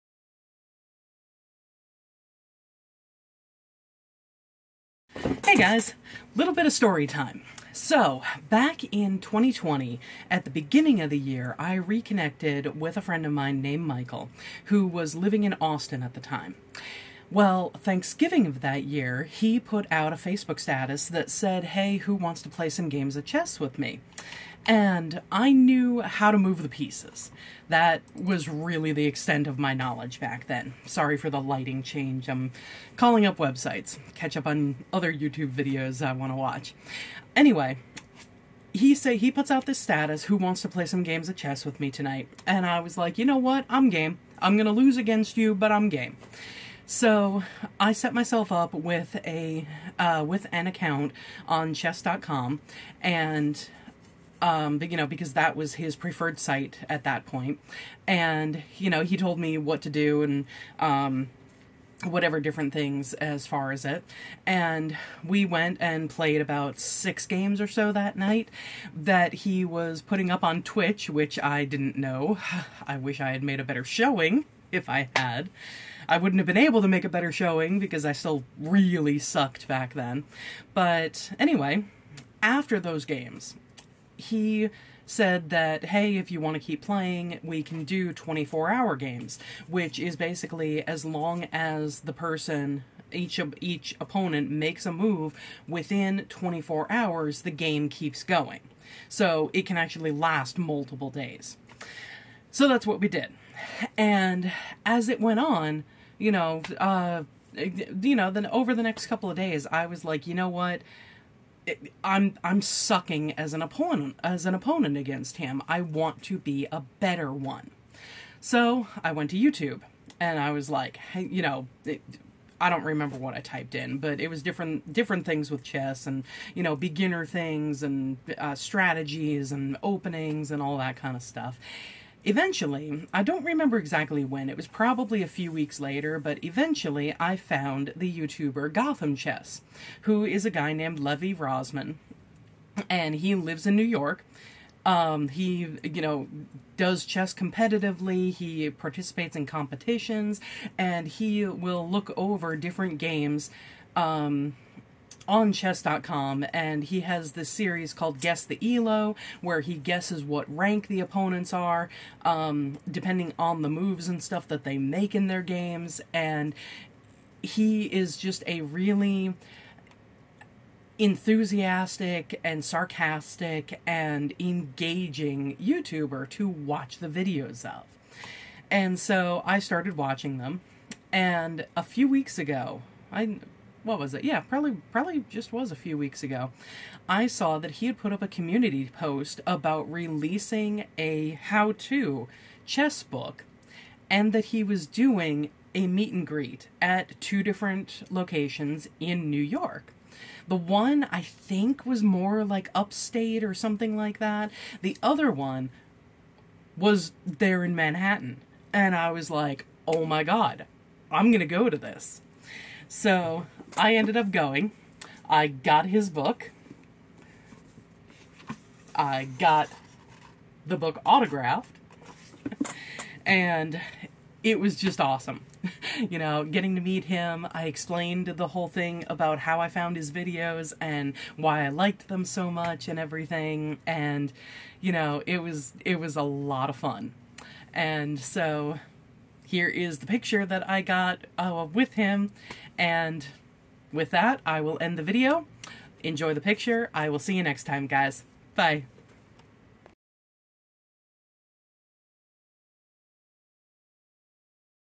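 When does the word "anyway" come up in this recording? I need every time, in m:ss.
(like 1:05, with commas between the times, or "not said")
0:37, 1:21.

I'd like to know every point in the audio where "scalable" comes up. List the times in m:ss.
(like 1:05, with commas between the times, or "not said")
not said.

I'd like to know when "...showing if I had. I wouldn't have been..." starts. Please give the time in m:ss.
1:13.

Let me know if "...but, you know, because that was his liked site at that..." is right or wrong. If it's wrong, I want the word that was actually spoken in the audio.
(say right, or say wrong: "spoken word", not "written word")
wrong: "preferred", not "liked".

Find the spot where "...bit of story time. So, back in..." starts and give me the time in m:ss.
0:06.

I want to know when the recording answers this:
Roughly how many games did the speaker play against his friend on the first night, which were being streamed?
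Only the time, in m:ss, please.
1:06.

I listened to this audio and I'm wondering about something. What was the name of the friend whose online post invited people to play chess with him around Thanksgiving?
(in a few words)
Michael.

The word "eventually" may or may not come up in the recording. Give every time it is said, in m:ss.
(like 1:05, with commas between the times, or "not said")
2:12, 2:16.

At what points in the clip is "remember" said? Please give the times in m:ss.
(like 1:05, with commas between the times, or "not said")
2:02, 2:13.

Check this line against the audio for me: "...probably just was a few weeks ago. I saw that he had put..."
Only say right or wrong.
right.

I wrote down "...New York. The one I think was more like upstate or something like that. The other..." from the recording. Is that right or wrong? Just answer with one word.
right.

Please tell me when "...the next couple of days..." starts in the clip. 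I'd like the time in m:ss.
1:48.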